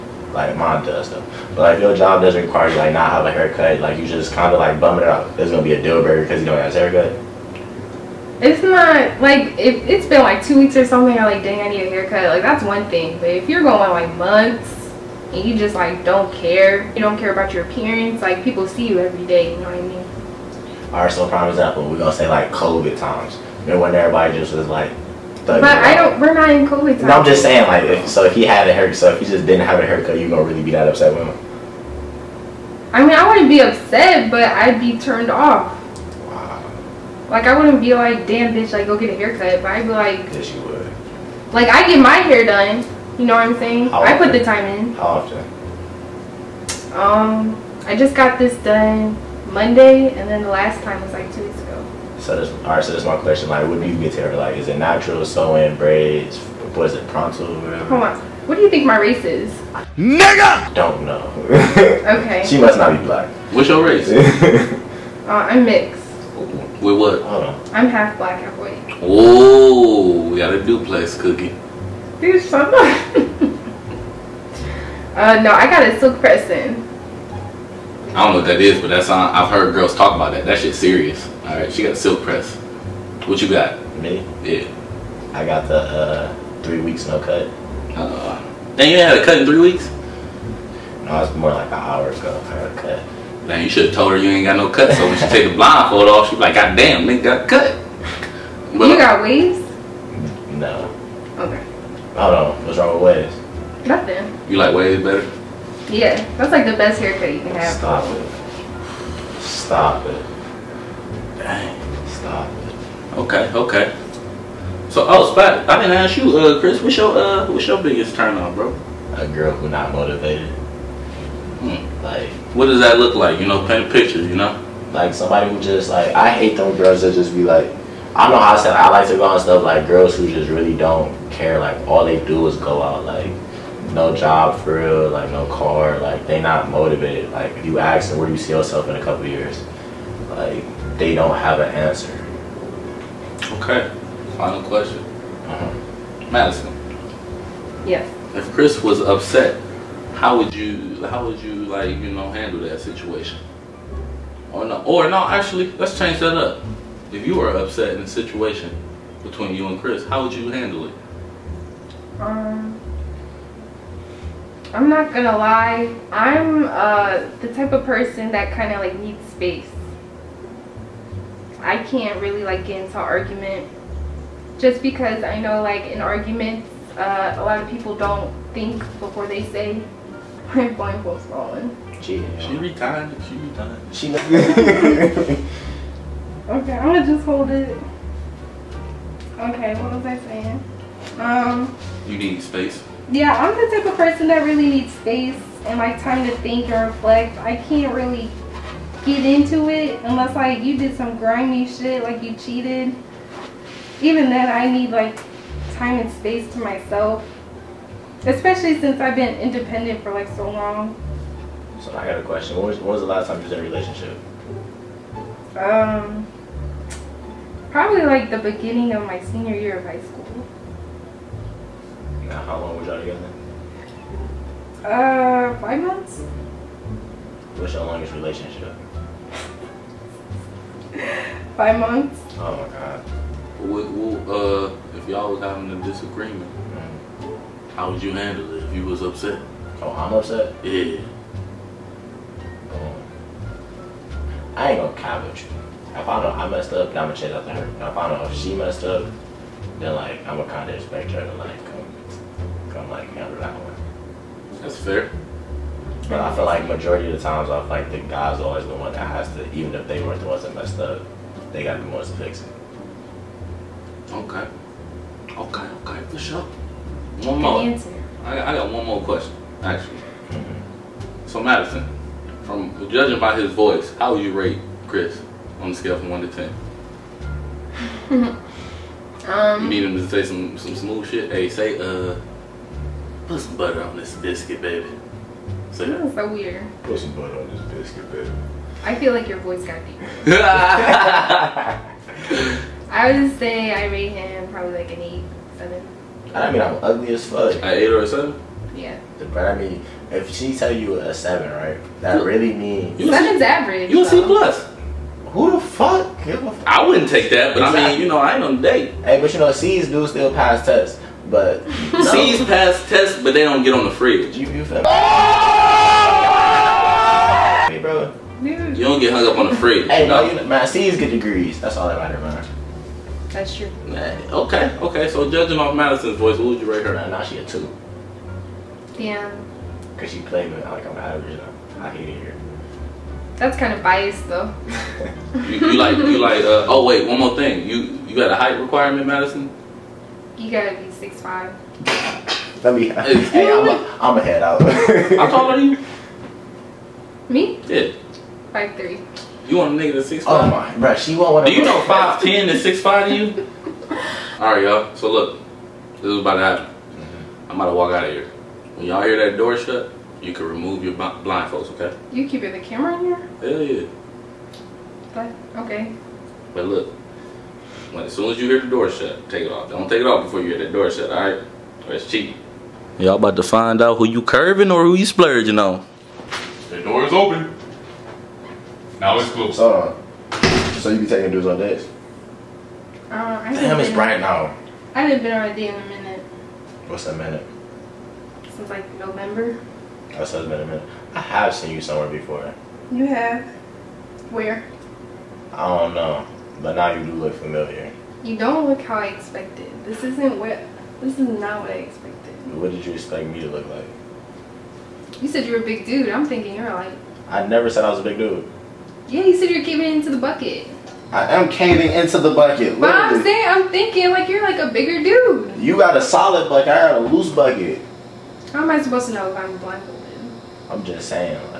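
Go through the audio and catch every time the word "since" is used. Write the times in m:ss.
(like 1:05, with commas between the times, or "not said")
3:28, 6:28.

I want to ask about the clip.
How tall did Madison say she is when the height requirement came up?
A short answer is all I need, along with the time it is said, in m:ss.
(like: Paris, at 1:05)
5'3", at 5:48.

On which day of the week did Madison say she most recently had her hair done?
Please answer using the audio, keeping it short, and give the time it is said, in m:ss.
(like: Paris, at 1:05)
Monday, at 0:49.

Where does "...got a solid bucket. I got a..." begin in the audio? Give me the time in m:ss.
6:55.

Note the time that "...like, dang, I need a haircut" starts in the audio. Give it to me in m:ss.
0:11.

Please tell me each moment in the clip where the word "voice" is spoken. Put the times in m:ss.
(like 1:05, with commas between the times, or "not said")
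4:33, 4:49, 5:26.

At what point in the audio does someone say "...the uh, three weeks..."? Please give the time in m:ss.
1:25.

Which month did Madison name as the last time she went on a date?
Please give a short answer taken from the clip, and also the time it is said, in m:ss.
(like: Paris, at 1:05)
November, at 6:28.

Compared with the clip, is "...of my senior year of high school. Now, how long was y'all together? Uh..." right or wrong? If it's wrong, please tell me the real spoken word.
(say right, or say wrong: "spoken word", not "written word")
right.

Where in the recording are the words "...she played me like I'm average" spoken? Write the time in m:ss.
5:30.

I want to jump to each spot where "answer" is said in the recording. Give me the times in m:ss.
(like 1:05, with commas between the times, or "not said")
2:21, 4:27.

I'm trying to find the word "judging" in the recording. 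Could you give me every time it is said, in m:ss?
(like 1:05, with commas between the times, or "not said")
4:32, 5:25.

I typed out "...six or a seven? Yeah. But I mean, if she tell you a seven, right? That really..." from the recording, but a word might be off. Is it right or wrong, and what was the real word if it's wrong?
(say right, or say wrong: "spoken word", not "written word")
wrong: "eight", not "six".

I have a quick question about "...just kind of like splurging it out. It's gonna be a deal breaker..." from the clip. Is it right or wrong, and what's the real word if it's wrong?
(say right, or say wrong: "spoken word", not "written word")
wrong: "bumming", not "splurging".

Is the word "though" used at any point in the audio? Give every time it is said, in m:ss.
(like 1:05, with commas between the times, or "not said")
0:01, 5:34.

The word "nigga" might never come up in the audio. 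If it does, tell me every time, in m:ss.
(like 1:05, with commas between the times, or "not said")
0:59, 1:37, 5:49.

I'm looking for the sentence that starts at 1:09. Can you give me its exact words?
Oh, we got a duplex cookie.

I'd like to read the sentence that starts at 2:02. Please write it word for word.
Like, what does that look like?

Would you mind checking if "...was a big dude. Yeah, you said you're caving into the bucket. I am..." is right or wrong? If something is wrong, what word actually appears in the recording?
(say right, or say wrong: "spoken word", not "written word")
right.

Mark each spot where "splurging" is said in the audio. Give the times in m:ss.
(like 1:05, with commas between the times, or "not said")
6:15.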